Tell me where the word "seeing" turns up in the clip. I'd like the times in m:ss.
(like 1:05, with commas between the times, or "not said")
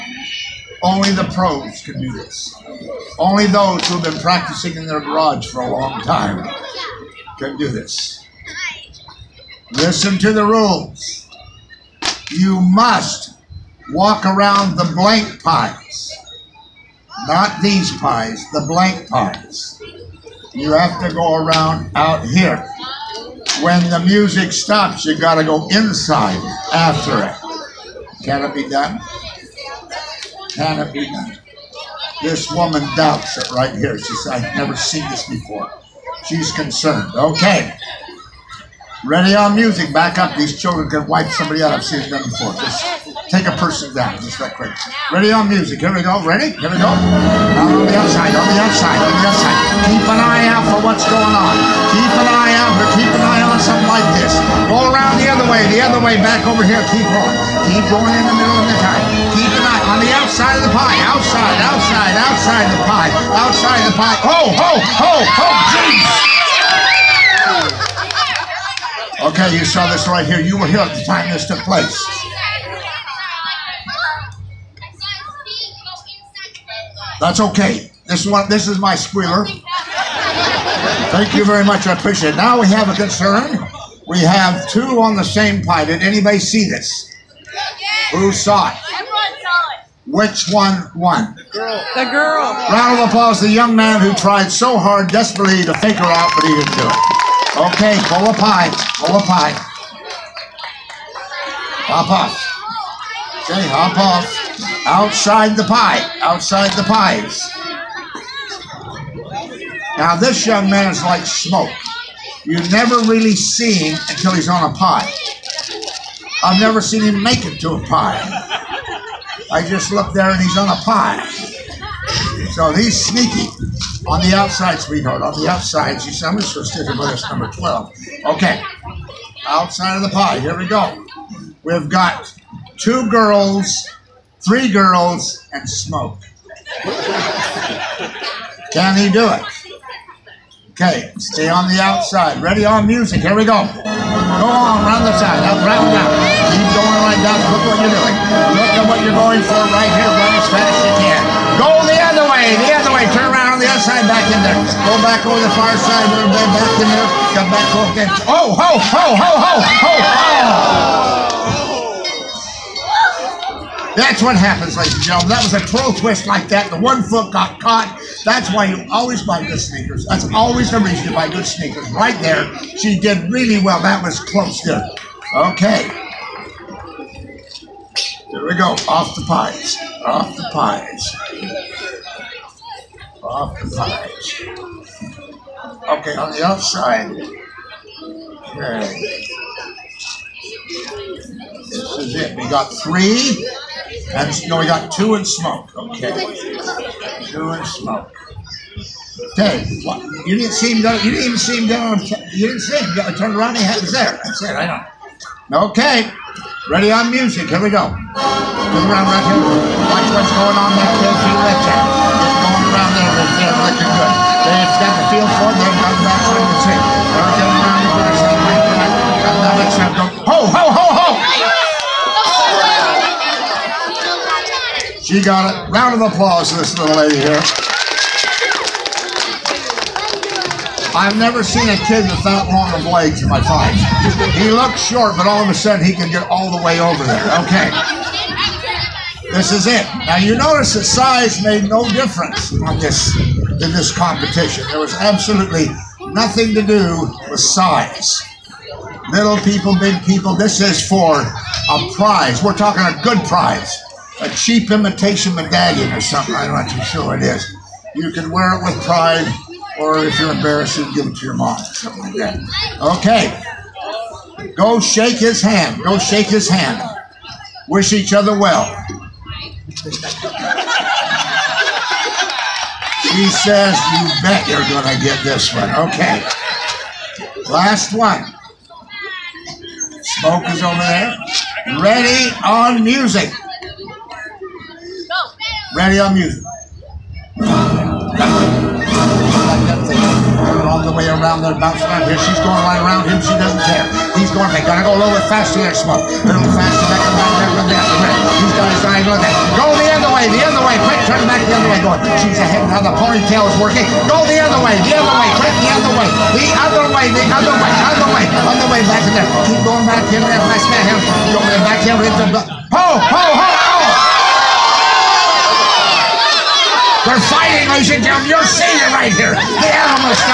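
5:18.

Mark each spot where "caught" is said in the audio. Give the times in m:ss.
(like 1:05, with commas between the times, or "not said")
2:47.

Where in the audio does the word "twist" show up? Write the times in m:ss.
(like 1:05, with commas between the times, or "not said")
2:45.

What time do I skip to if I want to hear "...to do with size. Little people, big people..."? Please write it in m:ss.
4:06.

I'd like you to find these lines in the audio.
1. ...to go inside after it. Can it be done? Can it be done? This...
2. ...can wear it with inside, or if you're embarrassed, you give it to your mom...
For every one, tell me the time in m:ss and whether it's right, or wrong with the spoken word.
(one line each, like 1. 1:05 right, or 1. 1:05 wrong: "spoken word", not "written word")
1. 0:25 right
2. 4:18 wrong: "pride", not "inside".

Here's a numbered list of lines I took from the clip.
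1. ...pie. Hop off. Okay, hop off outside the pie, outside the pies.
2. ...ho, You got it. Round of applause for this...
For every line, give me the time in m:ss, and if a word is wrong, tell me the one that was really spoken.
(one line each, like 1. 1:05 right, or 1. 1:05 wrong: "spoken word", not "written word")
1. 1:39 right
2. 3:40 wrong: "She", not "You".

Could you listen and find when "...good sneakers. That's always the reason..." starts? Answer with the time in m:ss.
2:49.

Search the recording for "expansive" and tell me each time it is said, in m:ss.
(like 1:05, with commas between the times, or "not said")
not said.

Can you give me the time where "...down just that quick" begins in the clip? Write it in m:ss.
0:43.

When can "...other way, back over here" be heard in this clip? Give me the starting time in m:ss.
0:55.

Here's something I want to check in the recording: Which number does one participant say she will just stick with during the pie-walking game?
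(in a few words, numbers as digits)
12.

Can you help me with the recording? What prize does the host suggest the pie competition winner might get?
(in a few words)
Cheap imitation medallion.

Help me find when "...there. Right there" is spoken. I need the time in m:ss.
3:32.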